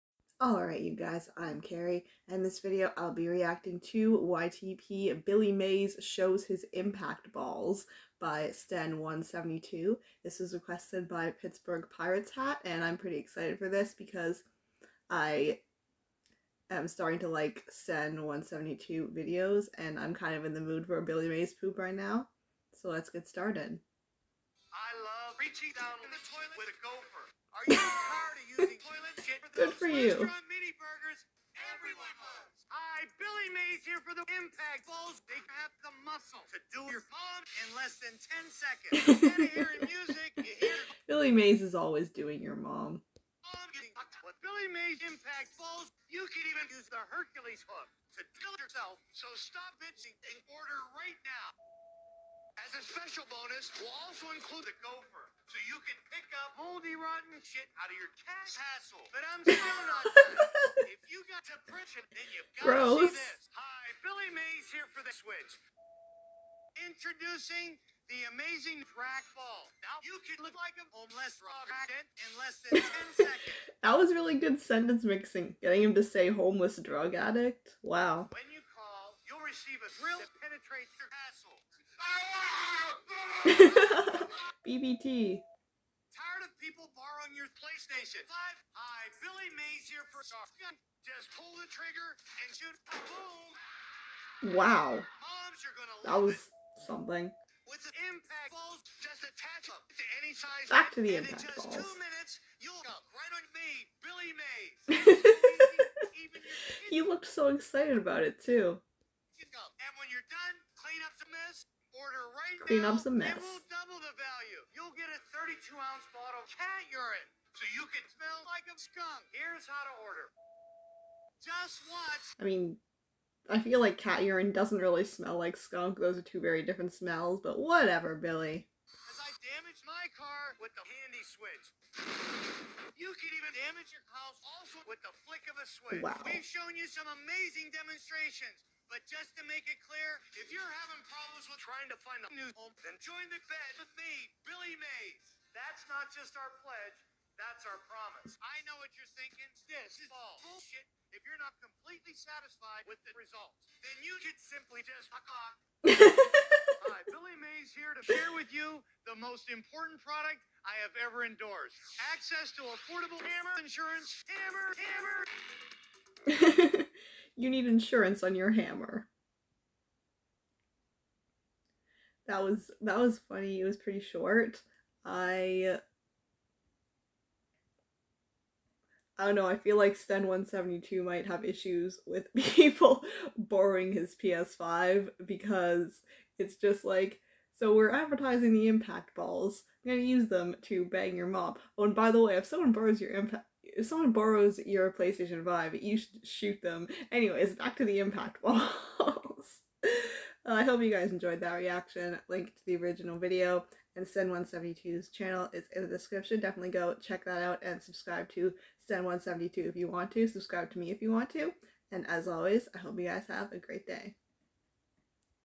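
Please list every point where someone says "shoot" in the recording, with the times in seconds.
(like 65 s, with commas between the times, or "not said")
92 s, 196 s.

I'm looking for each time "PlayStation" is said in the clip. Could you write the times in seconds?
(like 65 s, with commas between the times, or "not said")
87 s, 194 s.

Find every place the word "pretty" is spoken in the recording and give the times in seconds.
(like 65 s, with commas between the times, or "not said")
12 s, 173 s.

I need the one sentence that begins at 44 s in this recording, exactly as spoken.
With Billy Mays impact bowls, you can even use the Hercules hook to kill yourself.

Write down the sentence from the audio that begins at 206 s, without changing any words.
Definitely go check that out and subscribe to Sen172 if you want to.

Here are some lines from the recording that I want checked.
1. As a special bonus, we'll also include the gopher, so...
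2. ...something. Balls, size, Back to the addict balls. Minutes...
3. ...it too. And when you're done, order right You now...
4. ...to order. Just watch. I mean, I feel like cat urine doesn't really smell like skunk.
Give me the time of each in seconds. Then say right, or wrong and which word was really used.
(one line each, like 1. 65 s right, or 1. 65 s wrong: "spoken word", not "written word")
1. 52 s right
2. 96 s wrong: "impact", not "addict"
3. 108 s wrong: "Clean", not "You"
4. 119 s right.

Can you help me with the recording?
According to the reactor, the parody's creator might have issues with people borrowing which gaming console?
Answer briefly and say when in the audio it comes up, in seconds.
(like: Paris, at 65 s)
PS5, at 184 s.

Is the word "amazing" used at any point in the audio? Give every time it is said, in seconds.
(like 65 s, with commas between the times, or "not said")
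68 s, 137 s.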